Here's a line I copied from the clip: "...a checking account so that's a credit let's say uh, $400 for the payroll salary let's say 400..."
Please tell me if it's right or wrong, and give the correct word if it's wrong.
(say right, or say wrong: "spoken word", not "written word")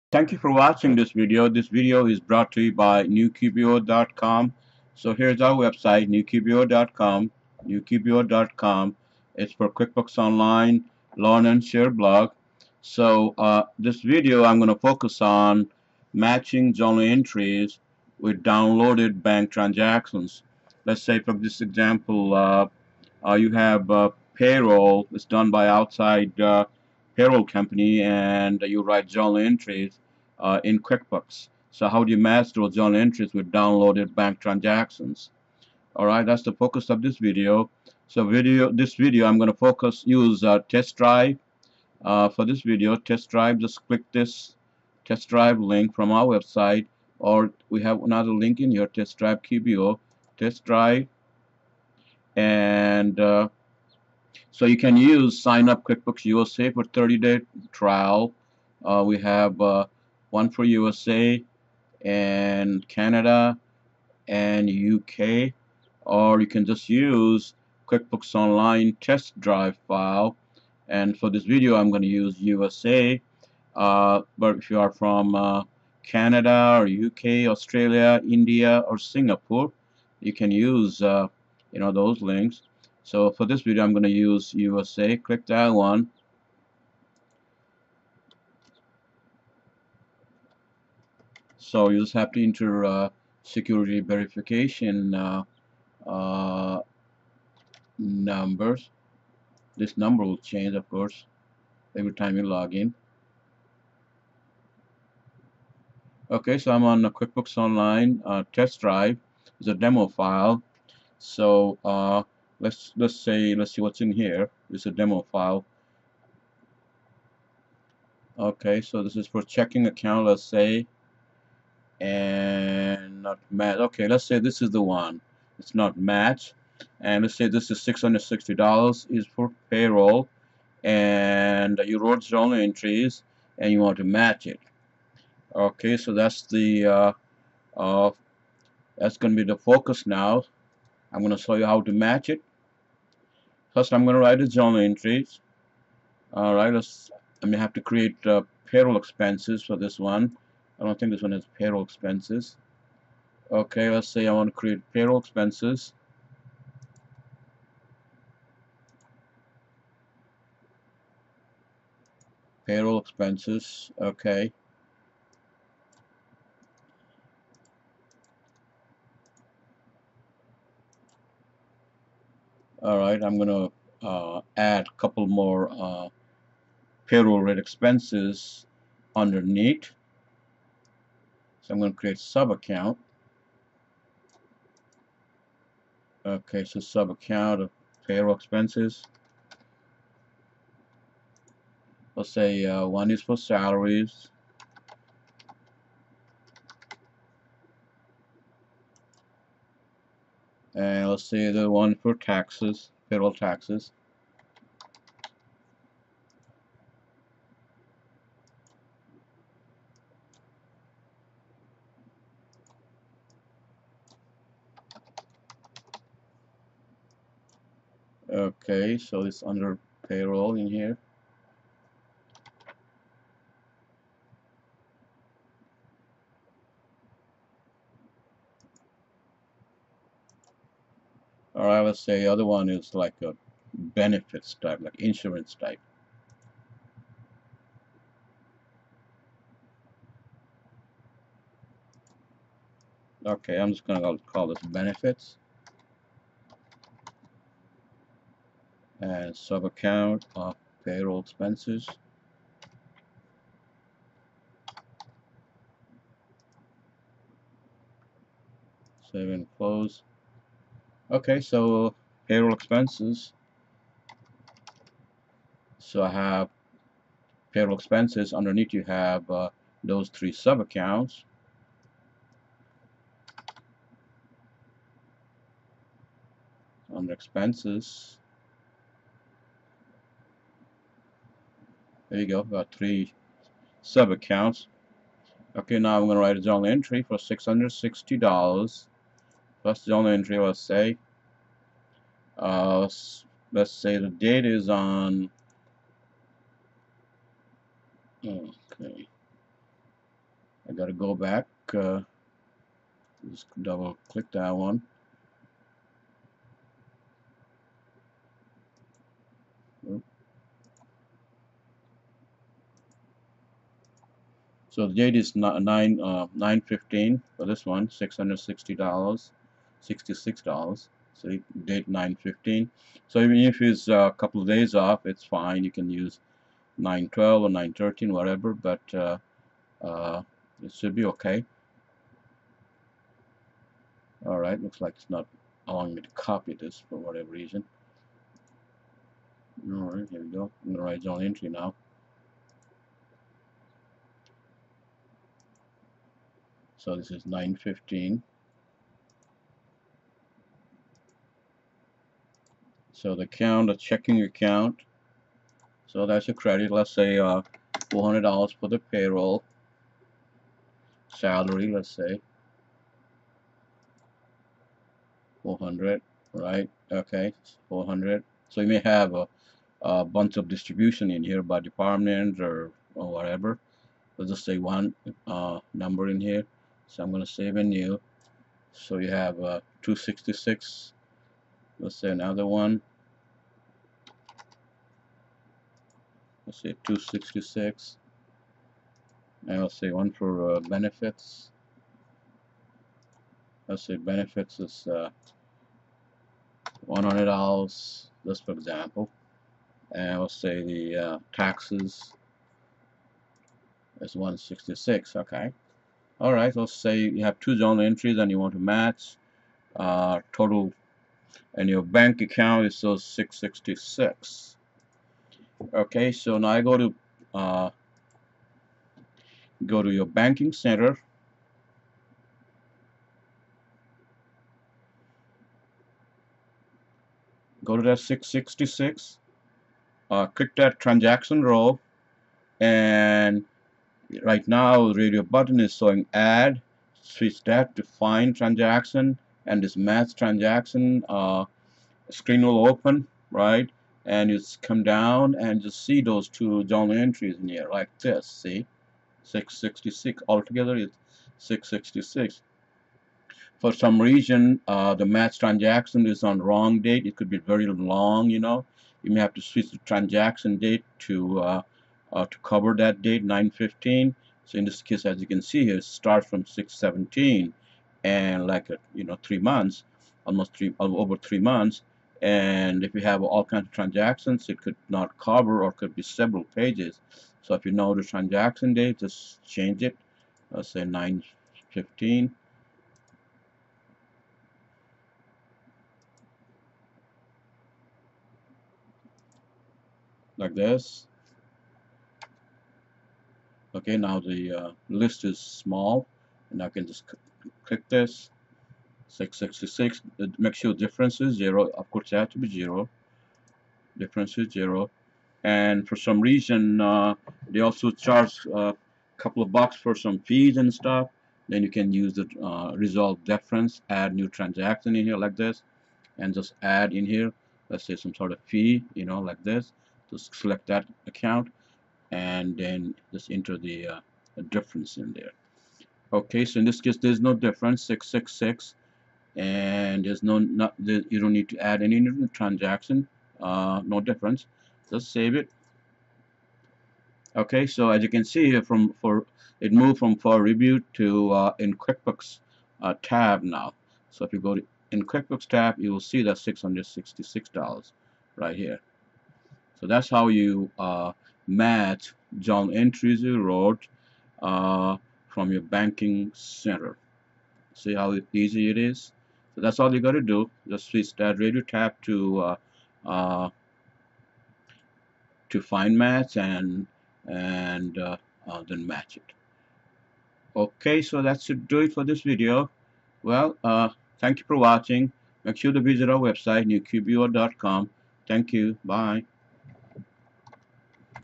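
right.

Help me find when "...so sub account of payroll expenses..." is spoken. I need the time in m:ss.
3:06.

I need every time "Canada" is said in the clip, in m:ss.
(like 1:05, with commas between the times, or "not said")
1:02, 1:16.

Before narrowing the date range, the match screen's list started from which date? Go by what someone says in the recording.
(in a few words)
6/17.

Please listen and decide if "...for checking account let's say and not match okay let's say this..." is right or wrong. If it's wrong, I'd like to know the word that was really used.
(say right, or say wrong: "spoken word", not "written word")
right.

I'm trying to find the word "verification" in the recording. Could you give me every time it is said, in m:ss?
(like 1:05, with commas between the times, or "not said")
1:34.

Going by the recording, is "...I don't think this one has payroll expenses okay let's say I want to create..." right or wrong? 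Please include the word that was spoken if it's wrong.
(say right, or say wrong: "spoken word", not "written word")
right.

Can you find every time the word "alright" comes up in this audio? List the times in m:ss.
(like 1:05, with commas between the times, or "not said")
0:35, 2:26, 2:52, 5:34, 5:39, 6:46.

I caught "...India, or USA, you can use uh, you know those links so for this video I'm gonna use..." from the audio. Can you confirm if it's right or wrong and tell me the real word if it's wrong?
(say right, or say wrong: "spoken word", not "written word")
wrong: "Singapore", not "USA".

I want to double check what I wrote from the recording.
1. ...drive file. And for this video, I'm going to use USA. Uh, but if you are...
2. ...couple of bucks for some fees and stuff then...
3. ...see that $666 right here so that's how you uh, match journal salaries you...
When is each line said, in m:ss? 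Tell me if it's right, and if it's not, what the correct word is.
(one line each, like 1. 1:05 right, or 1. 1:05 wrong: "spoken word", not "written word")
1. 1:09 right
2. 8:29 right
3. 9:06 wrong: "entries", not "salaries".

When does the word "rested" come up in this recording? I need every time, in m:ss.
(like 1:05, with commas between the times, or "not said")
not said.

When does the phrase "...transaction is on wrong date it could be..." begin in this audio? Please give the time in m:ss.
7:35.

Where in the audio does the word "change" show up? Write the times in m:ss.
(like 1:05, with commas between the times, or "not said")
1:40, 7:59.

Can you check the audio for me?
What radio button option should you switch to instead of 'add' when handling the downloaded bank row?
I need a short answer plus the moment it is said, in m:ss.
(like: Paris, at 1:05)
Find transaction, at 7:17.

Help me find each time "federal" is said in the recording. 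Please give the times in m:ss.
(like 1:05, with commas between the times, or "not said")
3:23.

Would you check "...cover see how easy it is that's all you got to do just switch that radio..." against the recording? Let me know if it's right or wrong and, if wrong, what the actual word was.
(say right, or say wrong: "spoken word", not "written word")
wrong: "center", not "cover".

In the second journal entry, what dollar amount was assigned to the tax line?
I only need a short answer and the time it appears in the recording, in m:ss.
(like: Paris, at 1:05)
$166, at 6:44.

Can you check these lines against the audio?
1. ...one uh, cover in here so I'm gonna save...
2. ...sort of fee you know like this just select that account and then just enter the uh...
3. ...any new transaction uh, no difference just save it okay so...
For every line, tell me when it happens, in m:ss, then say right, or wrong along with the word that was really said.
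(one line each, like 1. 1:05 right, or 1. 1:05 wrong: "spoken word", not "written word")
1. 6:14 wrong: "number", not "cover"
2. 8:38 right
3. 8:51 right.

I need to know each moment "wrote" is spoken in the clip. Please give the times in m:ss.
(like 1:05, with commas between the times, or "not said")
2:11, 9:13.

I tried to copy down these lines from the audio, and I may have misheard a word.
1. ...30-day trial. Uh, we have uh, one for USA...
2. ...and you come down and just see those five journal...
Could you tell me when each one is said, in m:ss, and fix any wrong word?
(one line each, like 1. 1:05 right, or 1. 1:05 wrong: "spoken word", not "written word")
1. 0:56 right
2. 7:24 wrong: "two", not "five".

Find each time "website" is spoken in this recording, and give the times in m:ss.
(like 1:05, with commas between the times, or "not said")
0:05, 0:46, 9:36.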